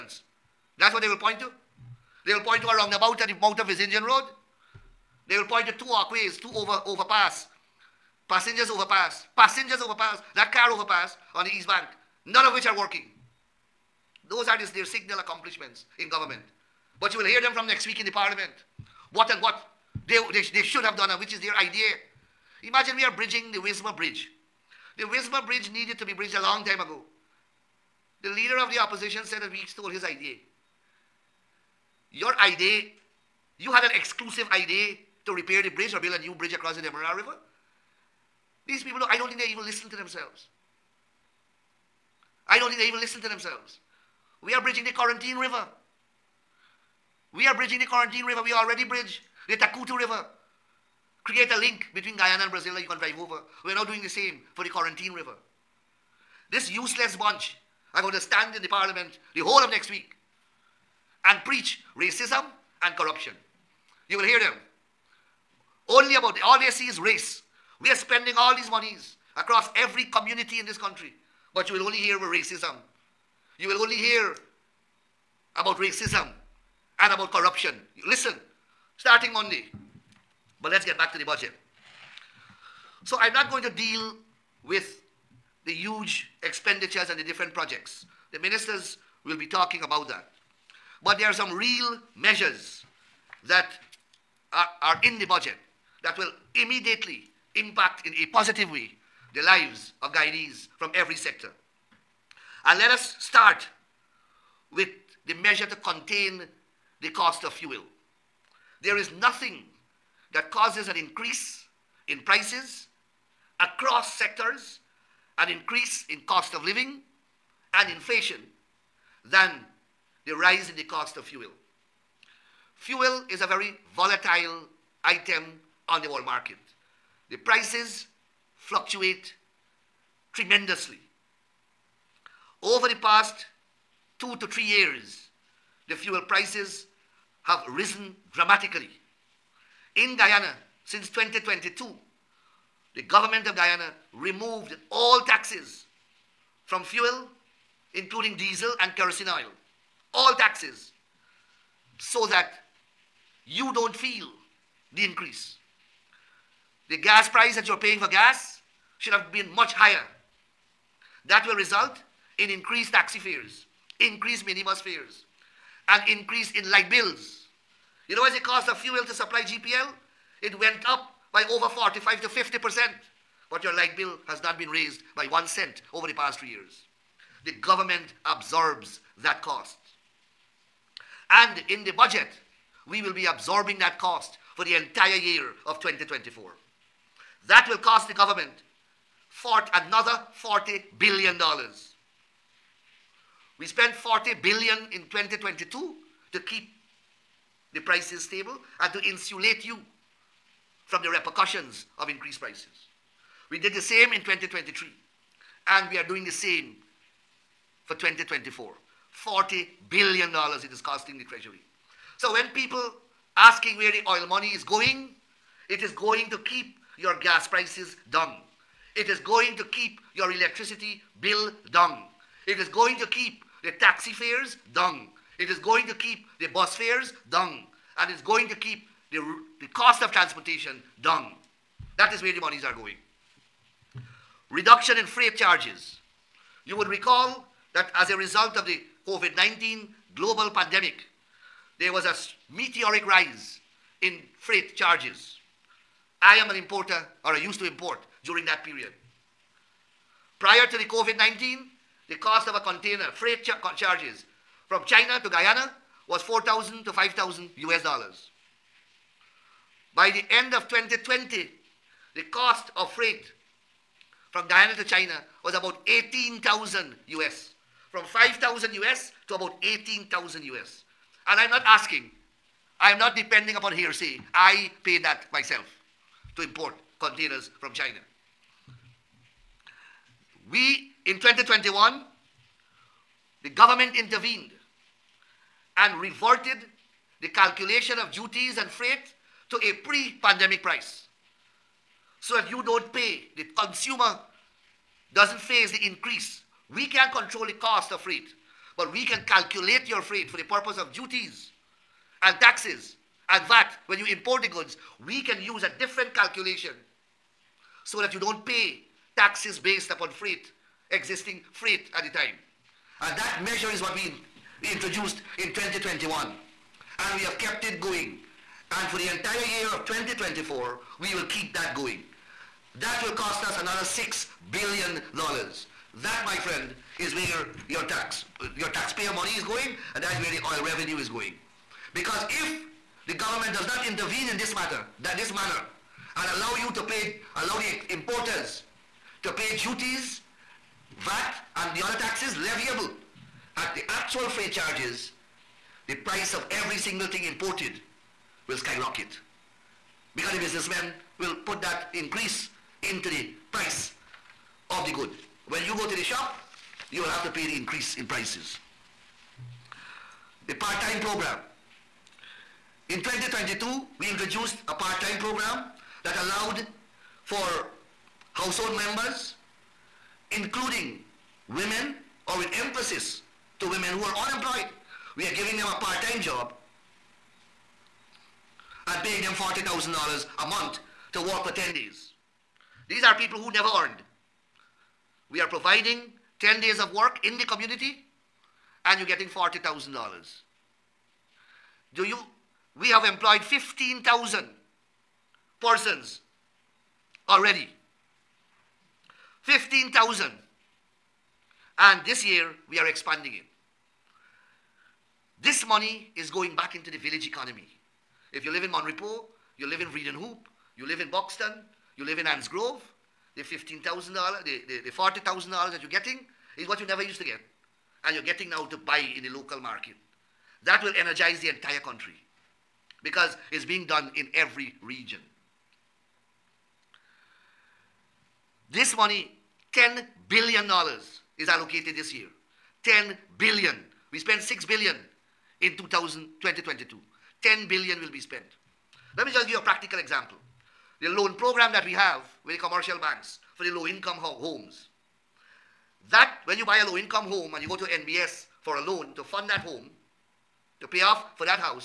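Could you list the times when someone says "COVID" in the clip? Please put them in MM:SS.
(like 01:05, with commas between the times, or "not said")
03:59, 04:10.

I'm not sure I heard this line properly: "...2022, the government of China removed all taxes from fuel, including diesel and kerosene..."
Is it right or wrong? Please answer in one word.
wrong.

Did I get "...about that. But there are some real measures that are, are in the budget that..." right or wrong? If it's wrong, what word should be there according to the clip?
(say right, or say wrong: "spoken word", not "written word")
right.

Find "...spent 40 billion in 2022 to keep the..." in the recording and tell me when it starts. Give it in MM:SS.
03:13.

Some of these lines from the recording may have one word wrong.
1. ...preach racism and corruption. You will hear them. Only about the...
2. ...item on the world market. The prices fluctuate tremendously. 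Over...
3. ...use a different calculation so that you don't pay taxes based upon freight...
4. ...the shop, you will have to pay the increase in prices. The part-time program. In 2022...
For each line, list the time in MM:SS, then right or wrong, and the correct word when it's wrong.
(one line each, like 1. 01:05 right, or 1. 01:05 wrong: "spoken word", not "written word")
1. 01:01 right
2. 02:05 right
3. 05:05 right
4. 05:55 right.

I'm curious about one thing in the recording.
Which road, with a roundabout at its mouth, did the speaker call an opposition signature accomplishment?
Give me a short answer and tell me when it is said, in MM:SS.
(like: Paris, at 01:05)
Vlissengen Road, at 00:03.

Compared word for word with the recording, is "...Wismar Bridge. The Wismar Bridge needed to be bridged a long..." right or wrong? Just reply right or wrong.
right.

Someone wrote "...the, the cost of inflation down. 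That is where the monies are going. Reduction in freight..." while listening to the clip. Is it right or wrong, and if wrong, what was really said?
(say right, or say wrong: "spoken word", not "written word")
wrong: "transportation", not "inflation".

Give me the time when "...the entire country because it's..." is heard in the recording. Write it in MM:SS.
07:01.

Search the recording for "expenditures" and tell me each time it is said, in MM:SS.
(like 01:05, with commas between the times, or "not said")
01:26.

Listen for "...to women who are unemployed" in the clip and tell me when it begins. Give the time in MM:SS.
06:13.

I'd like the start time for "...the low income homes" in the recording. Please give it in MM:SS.
07:23.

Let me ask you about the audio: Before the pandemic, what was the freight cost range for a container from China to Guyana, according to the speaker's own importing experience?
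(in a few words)
4,000 to 5,000 US dollars.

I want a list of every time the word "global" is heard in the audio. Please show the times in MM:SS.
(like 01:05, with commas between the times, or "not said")
04:00.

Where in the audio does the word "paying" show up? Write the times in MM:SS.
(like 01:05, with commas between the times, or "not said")
02:37, 06:19.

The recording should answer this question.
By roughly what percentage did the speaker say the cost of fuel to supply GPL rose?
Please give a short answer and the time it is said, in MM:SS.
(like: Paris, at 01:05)
45 to 50%, at 02:51.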